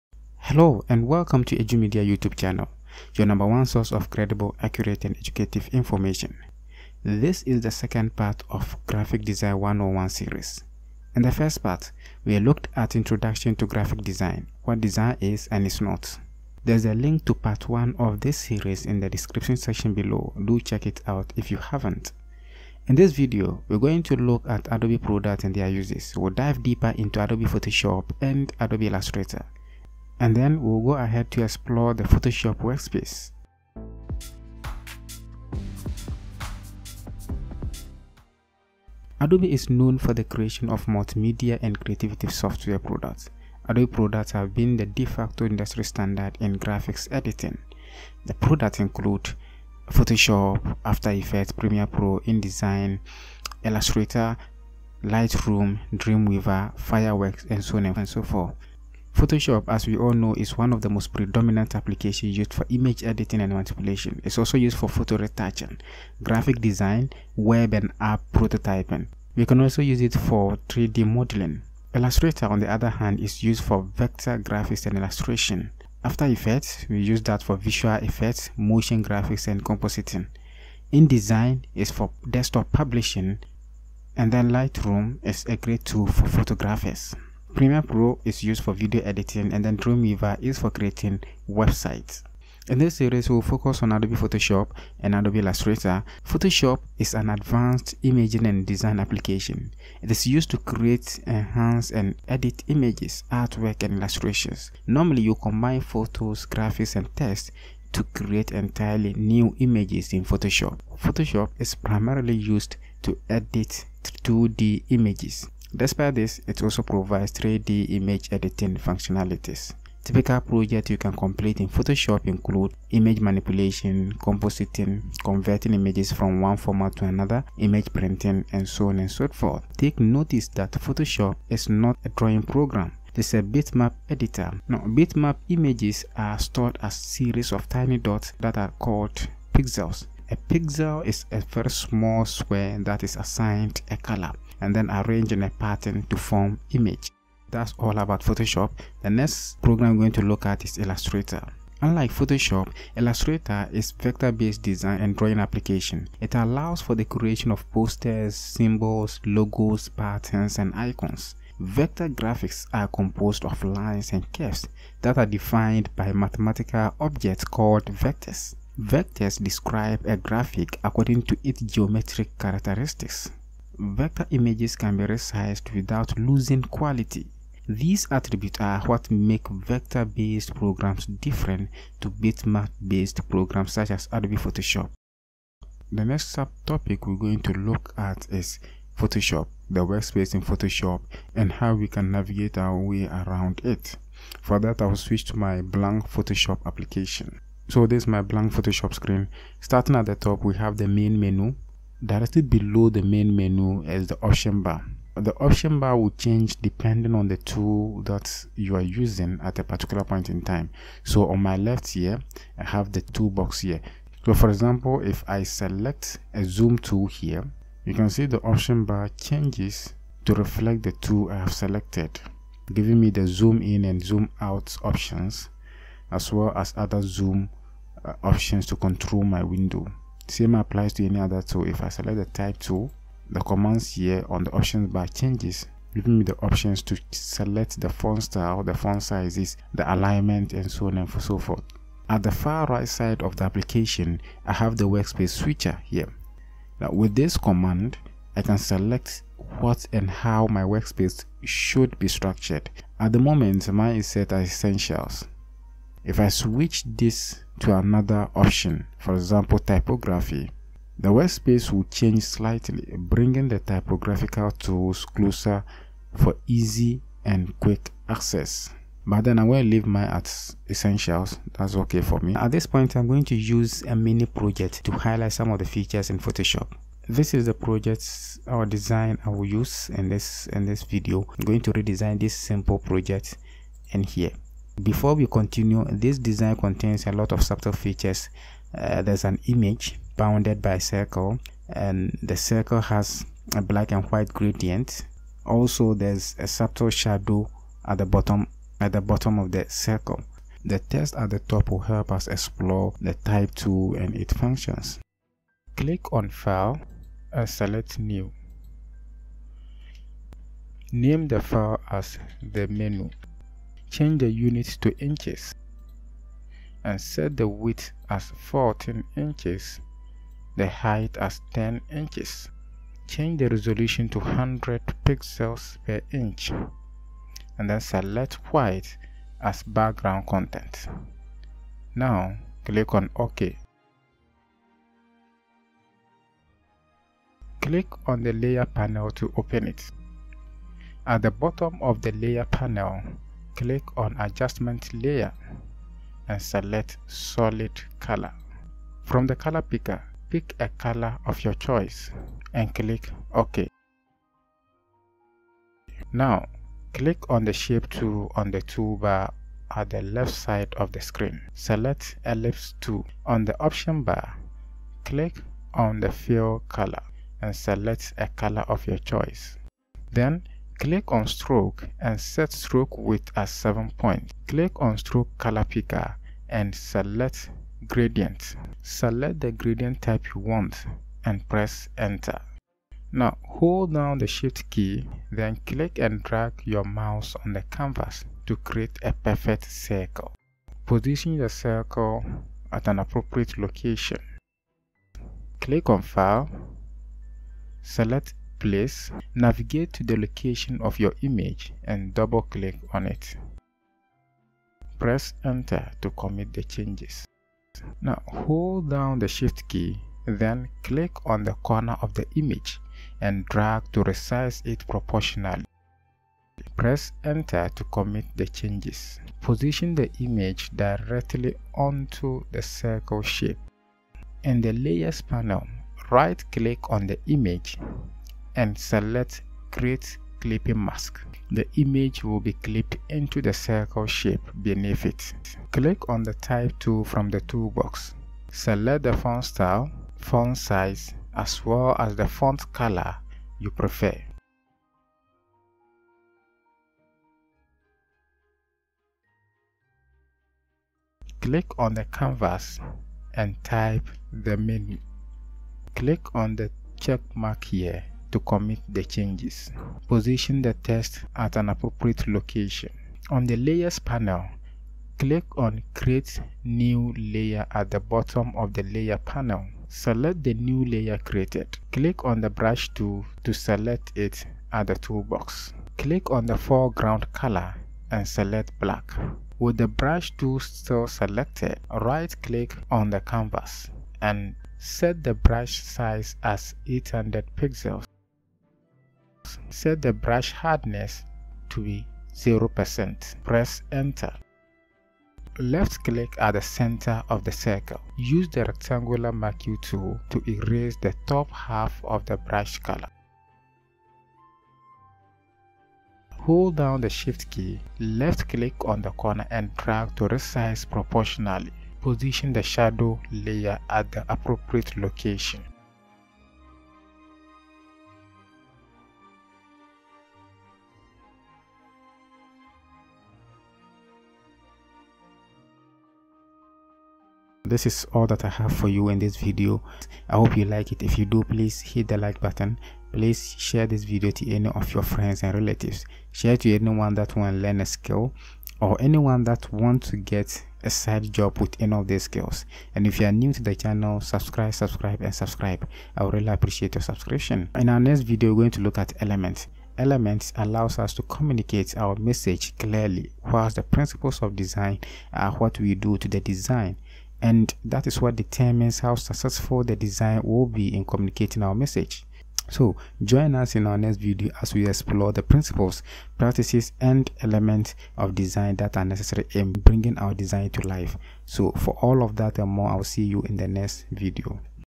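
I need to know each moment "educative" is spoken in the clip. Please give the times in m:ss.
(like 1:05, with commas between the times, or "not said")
0:05.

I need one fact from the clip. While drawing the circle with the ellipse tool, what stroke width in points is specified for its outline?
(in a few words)
7 points.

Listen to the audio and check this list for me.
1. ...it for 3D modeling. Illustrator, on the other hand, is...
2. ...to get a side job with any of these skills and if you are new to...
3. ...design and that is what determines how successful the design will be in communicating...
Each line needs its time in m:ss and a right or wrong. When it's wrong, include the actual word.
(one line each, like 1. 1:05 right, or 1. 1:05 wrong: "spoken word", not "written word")
1. 1:10 right
2. 9:00 right
3. 9:16 right.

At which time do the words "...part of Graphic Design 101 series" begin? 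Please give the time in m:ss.
0:08.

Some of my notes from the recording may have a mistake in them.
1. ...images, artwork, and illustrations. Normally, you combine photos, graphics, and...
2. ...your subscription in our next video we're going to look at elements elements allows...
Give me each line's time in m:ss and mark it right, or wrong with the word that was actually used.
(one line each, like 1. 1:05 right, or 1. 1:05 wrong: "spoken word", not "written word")
1. 1:42 right
2. 9:06 right.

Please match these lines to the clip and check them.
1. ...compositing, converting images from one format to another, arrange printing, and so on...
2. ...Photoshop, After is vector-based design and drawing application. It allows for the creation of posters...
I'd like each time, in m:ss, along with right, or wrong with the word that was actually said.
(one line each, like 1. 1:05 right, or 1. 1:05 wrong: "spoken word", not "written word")
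1. 2:04 wrong: "image", not "arrange"
2. 2:32 wrong: "Illustrator", not "After".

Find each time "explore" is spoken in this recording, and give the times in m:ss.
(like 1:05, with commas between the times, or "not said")
0:31, 5:02, 9:24.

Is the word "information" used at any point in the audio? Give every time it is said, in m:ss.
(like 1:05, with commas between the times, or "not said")
0:05.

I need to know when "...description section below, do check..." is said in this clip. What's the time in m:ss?
0:19.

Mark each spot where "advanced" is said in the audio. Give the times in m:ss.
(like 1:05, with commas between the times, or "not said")
1:37.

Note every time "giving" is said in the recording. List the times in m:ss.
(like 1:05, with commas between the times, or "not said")
3:42, 3:55.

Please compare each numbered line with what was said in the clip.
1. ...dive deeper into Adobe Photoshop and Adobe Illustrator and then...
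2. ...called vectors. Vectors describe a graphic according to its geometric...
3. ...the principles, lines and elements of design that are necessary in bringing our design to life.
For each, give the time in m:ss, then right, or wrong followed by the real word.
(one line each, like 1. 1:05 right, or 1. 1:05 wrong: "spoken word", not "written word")
1. 0:26 right
2. 2:47 right
3. 9:25 wrong: "practices", not "lines".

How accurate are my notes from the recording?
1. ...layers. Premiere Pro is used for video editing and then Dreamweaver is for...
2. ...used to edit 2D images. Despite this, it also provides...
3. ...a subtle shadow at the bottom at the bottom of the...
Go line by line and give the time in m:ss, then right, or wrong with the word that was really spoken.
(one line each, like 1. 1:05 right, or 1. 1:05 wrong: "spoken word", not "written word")
1. 1:26 wrong: "photographers", not "layers"
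2. 1:52 right
3. 4:56 right.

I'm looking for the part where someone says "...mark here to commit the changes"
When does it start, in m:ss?
7:37.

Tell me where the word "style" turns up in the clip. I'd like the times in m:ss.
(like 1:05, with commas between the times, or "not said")
3:58, 7:19.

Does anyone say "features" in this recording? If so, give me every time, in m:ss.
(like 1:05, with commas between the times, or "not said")
4:35, 4:47.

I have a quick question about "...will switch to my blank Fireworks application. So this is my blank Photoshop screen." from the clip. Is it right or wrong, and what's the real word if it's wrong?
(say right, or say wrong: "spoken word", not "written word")
wrong: "Photoshop", not "Fireworks".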